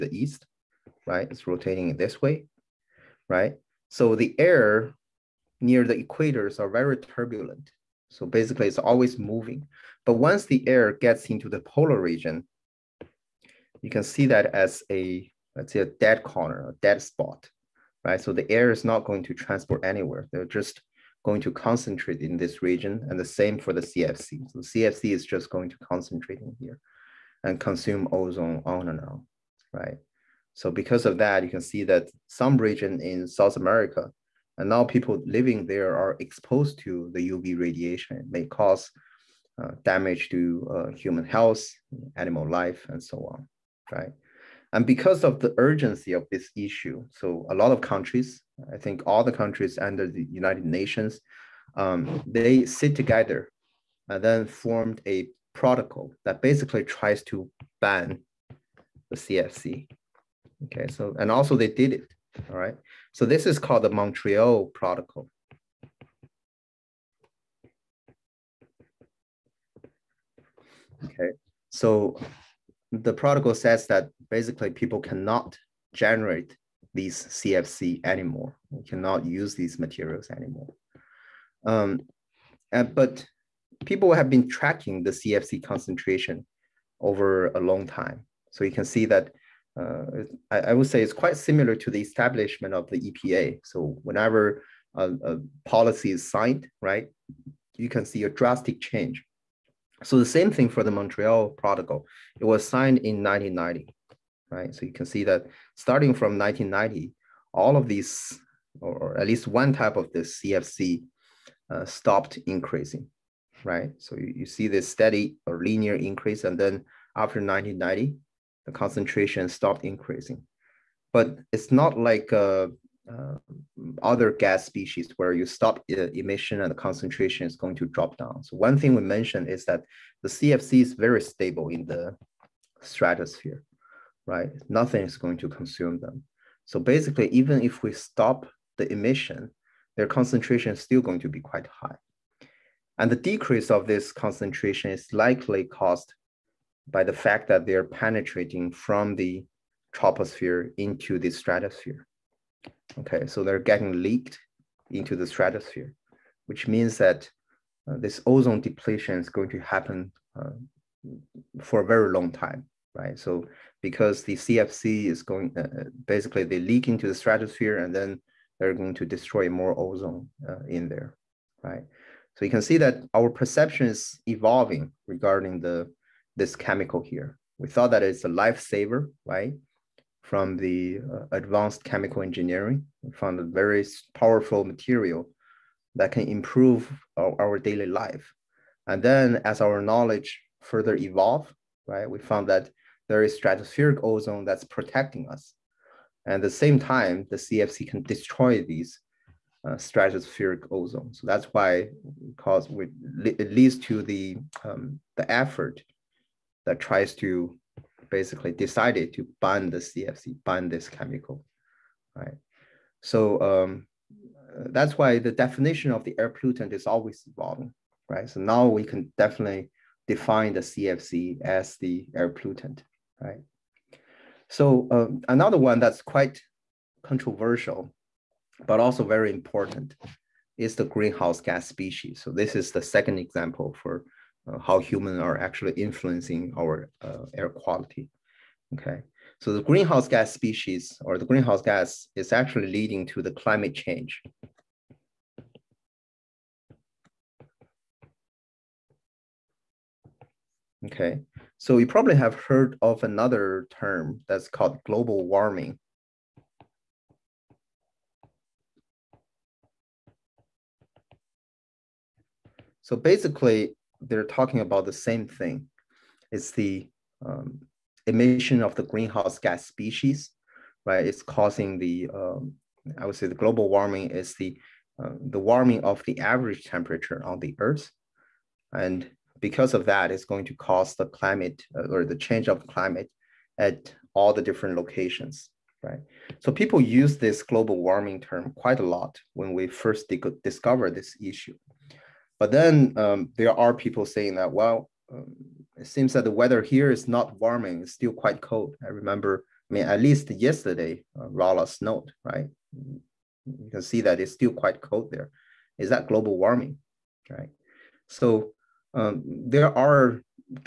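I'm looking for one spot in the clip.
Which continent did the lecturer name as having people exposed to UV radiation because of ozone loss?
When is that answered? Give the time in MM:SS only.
00:33.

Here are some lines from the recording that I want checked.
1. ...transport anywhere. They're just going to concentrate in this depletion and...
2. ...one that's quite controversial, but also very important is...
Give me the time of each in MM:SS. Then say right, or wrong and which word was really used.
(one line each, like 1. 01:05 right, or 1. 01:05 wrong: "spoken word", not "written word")
1. 00:19 wrong: "region", not "depletion"
2. 03:45 right.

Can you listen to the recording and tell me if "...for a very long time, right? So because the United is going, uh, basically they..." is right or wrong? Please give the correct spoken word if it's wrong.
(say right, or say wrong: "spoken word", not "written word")
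wrong: "CFC", not "United".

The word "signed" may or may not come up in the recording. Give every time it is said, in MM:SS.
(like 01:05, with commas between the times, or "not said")
01:36, 01:42.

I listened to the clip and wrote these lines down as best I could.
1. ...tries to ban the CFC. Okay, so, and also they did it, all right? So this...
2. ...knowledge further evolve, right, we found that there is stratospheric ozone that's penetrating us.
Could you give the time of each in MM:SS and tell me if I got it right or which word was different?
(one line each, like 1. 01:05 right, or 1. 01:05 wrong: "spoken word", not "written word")
1. 00:56 right
2. 03:09 wrong: "protecting", not "penetrating".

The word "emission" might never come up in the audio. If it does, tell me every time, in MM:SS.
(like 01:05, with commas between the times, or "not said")
02:05, 02:18, 04:28.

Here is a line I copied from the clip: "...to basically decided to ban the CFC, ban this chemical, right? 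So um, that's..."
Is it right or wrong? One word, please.
right.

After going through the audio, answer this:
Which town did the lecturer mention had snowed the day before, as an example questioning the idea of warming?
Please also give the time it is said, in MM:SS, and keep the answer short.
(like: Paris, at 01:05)
Rolla, at 05:01.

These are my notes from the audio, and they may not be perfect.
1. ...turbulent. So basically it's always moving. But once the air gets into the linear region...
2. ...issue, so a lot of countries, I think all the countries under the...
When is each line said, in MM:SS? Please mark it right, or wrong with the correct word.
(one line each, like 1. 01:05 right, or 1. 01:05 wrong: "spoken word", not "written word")
1. 00:06 wrong: "polar", not "linear"
2. 00:46 right.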